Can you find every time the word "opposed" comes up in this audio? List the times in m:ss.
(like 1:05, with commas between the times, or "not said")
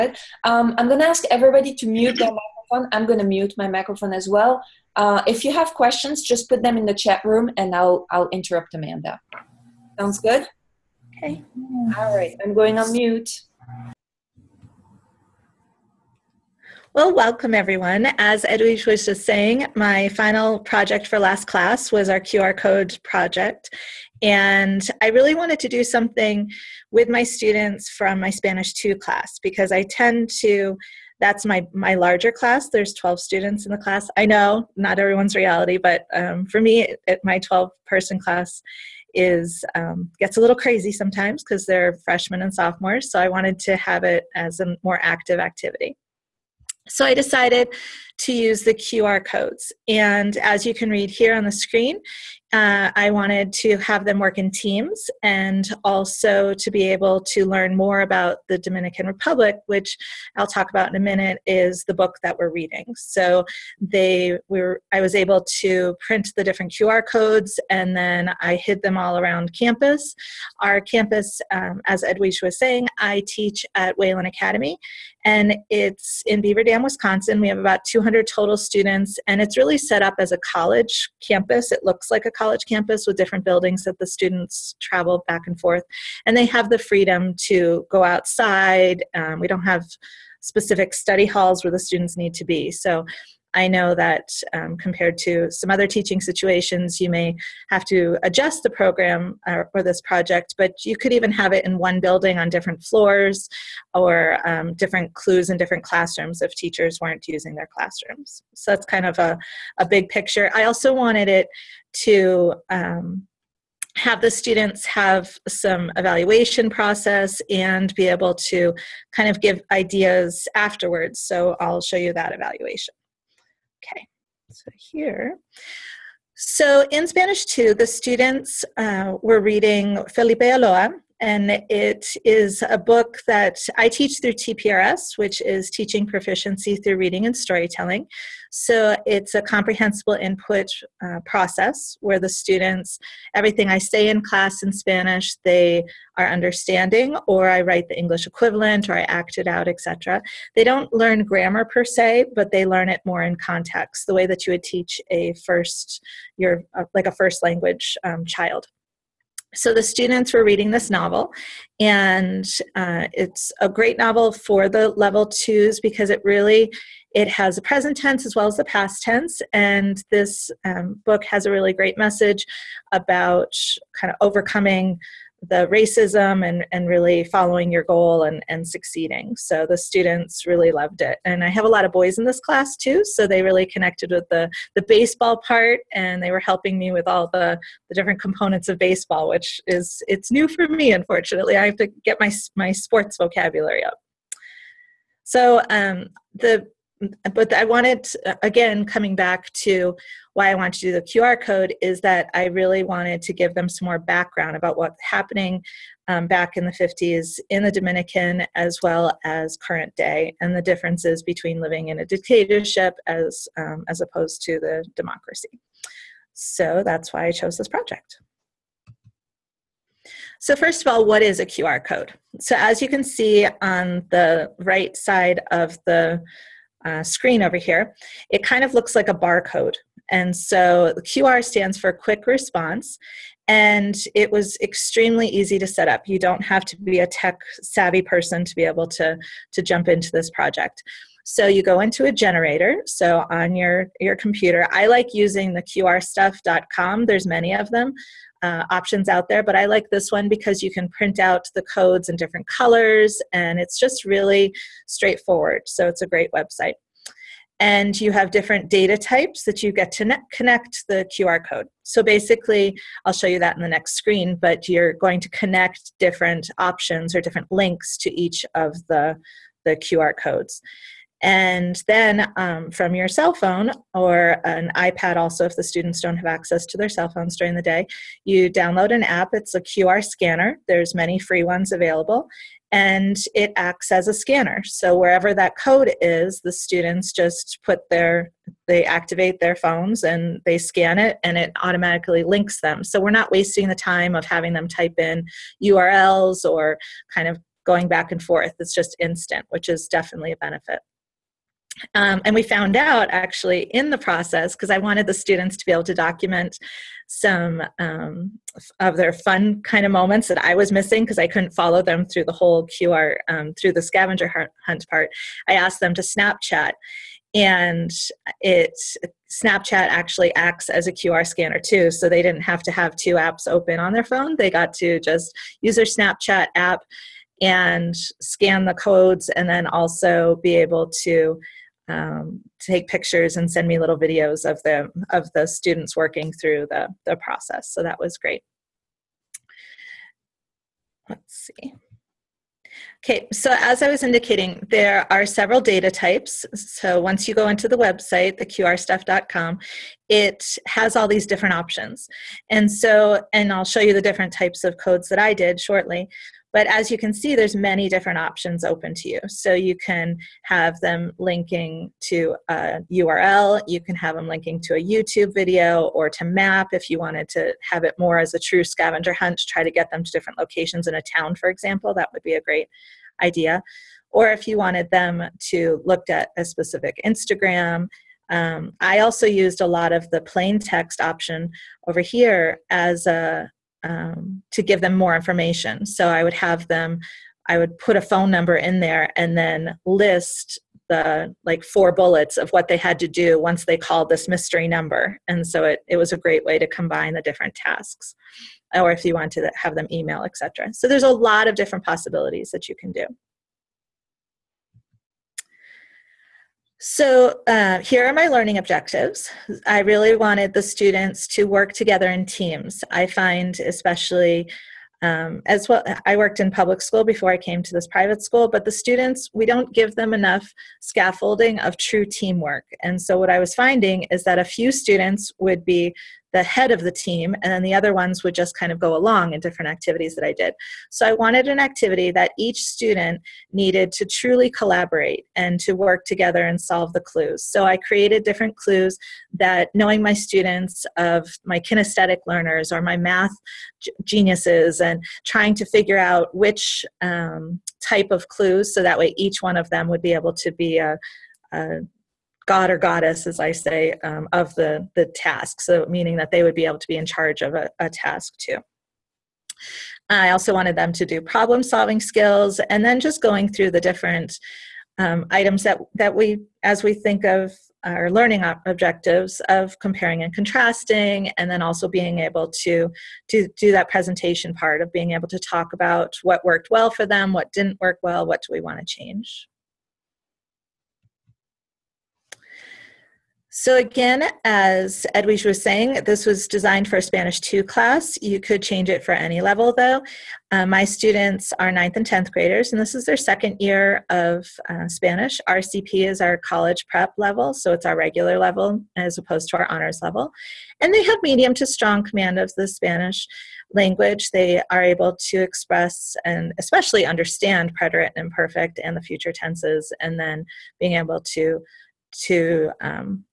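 3:34, 8:19.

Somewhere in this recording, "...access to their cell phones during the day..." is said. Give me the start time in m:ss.
4:36.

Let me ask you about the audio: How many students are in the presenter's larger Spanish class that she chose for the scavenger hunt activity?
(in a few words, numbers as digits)
12.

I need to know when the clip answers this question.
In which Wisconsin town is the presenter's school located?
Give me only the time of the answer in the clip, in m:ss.
1:16.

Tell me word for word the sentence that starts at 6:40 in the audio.
So there's a lot of different possibilities that you can do.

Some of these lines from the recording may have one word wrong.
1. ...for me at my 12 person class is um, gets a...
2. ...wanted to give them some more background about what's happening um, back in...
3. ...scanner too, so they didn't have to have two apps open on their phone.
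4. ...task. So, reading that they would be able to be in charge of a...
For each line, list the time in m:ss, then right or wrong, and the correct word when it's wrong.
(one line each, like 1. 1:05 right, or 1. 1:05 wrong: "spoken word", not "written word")
1. 0:36 right
2. 3:22 right
3. 5:21 right
4. 7:35 wrong: "meaning", not "reading".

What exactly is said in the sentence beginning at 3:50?
And so QR stands for quick response.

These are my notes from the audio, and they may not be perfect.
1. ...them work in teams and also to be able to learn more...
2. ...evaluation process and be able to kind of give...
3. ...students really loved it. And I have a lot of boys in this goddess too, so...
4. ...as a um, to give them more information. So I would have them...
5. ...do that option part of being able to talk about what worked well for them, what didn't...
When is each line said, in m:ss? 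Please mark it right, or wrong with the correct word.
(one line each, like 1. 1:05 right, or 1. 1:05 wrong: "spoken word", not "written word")
1. 0:54 right
2. 1:55 right
3. 2:59 wrong: "class", not "goddess"
4. 6:22 right
5. 7:53 wrong: "presentation", not "option".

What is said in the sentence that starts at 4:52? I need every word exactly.
So we're not wasting the time of having them type in URLs or kind of going back and forth.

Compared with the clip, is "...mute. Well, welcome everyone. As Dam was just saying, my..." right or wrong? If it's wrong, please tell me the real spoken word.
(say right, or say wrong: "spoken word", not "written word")
wrong: "Edwige", not "Dam".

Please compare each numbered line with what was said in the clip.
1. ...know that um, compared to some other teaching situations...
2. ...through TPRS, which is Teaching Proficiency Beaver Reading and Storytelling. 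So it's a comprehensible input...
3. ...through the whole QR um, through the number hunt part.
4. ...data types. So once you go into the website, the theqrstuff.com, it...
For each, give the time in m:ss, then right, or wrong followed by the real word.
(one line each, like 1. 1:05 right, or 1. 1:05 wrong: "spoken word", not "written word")
1. 1:33 right
2. 2:14 wrong: "Through", not "Beaver"
3. 5:12 wrong: "scavenger", not "number"
4. 5:45 right.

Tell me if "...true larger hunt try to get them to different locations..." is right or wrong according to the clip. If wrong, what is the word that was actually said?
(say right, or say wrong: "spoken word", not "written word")
wrong: "scavenger", not "larger".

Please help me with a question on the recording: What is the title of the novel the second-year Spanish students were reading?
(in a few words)
Felipe Alou.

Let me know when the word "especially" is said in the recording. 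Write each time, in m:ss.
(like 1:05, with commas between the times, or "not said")
6:53, 8:26.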